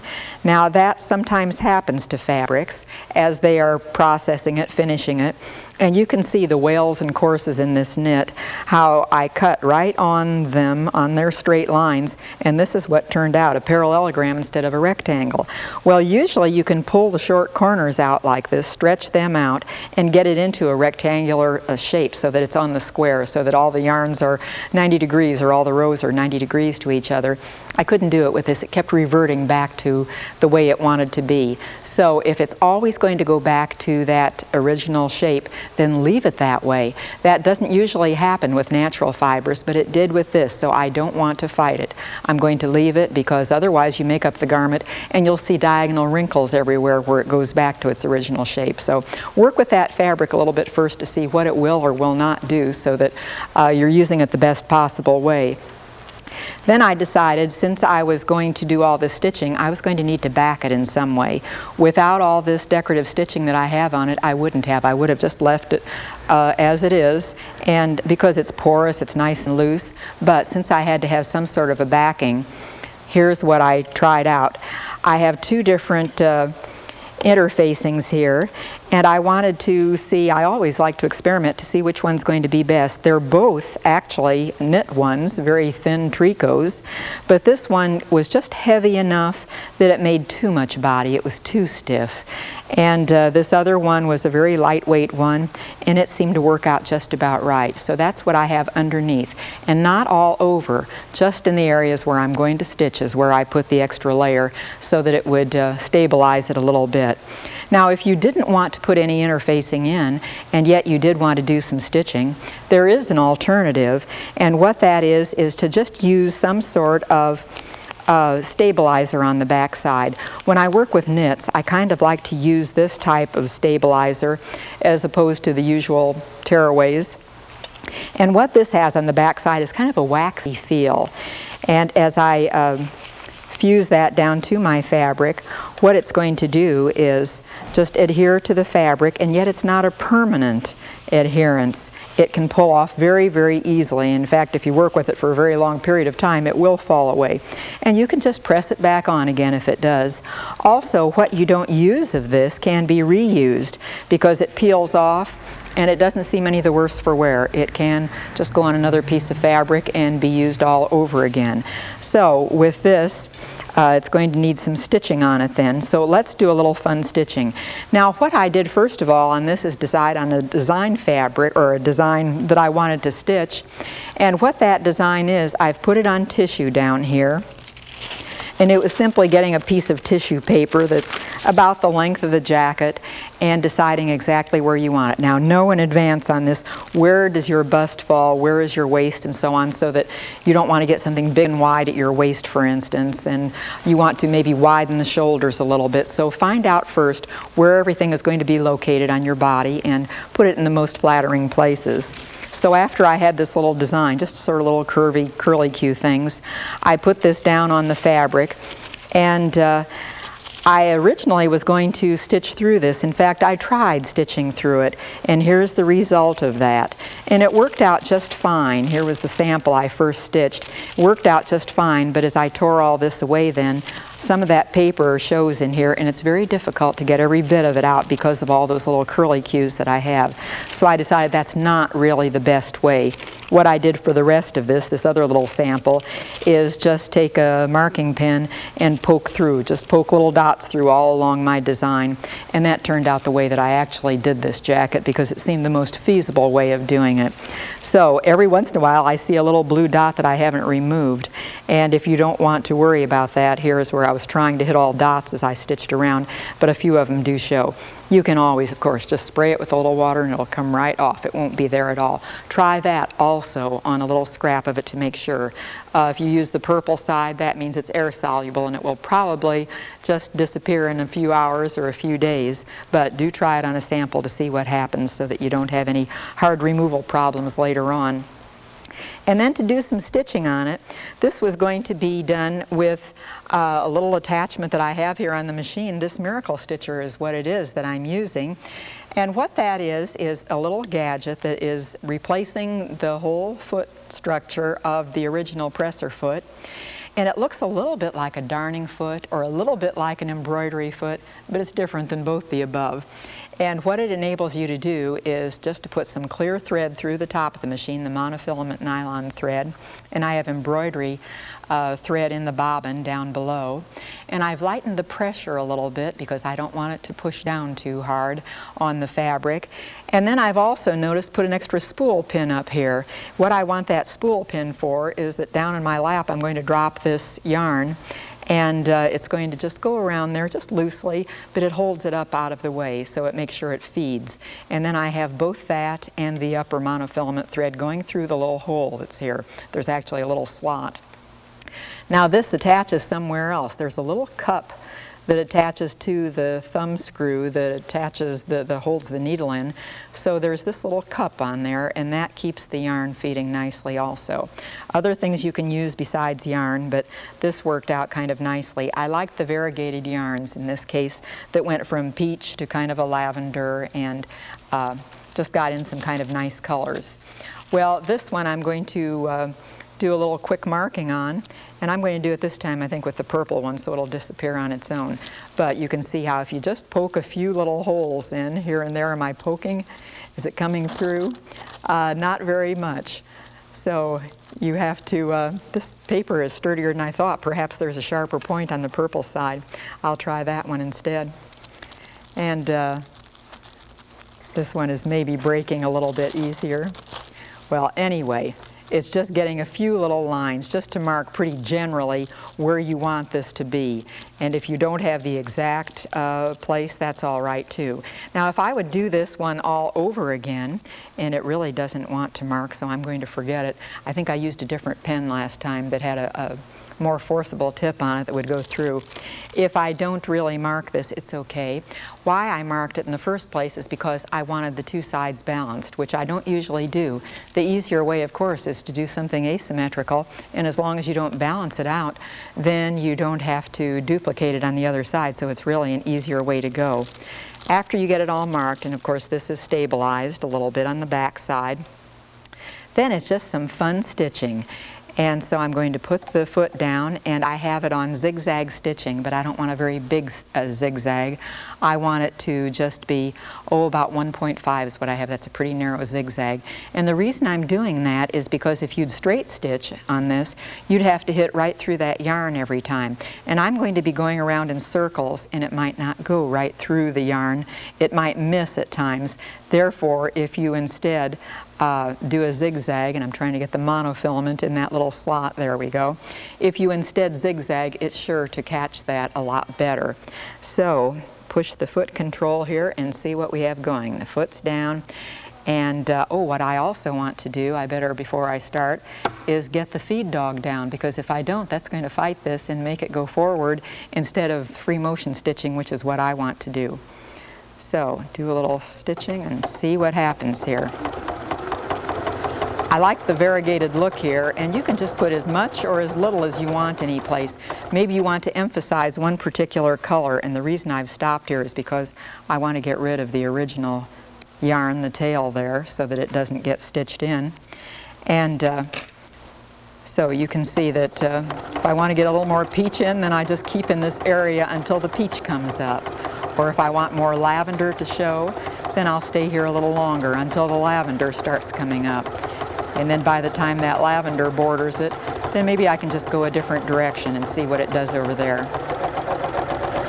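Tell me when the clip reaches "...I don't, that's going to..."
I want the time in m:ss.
8:11.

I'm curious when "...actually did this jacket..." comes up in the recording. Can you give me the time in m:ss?
4:03.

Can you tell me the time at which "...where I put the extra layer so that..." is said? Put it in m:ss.
1:43.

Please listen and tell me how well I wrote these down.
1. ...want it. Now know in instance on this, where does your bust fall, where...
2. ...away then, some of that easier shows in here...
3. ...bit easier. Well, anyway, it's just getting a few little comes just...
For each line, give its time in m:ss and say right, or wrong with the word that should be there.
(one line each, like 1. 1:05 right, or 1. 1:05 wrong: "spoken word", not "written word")
1. 3:04 wrong: "advance", not "instance"
2. 3:43 wrong: "paper", not "easier"
3. 6:36 wrong: "lines", not "comes".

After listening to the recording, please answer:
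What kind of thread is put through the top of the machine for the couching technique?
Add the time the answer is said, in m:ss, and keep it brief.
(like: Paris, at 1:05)
monofilament nylon thread, at 5:08.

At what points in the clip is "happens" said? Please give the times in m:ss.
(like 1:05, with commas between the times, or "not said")
0:01, 0:38, 4:34, 8:20.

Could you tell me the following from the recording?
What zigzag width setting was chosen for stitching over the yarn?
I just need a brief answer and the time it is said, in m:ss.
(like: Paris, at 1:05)
1.5, at 7:34.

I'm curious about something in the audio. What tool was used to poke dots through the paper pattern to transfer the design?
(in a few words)
marking pen.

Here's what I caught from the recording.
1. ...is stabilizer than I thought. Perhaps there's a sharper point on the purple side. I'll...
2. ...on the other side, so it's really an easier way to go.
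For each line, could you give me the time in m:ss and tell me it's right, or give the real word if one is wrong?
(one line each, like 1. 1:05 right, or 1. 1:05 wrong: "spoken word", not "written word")
1. 6:26 wrong: "sturdier", not "stabilizer"
2. 7:14 right.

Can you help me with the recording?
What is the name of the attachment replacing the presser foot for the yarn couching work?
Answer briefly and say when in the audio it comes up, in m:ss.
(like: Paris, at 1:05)
miracle stitcher, at 4:46.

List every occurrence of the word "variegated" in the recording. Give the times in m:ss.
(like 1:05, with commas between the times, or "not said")
5:59, 8:23.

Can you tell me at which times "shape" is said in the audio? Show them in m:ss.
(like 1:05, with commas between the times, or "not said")
0:21, 0:35, 0:48.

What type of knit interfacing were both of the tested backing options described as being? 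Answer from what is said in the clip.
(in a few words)
thin tricots.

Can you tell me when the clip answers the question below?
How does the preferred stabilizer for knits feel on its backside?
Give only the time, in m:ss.
2:09.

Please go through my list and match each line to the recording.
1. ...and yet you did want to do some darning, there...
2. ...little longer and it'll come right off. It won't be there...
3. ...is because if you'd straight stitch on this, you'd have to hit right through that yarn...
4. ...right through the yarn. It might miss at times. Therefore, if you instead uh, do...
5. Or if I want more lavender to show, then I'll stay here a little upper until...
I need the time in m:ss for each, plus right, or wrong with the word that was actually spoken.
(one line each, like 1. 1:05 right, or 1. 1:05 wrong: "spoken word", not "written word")
1. 1:50 wrong: "stitching", not "darning"
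2. 4:19 wrong: "water", not "longer"
3. 7:38 right
4. 7:46 right
5. 8:46 wrong: "longer", not "upper".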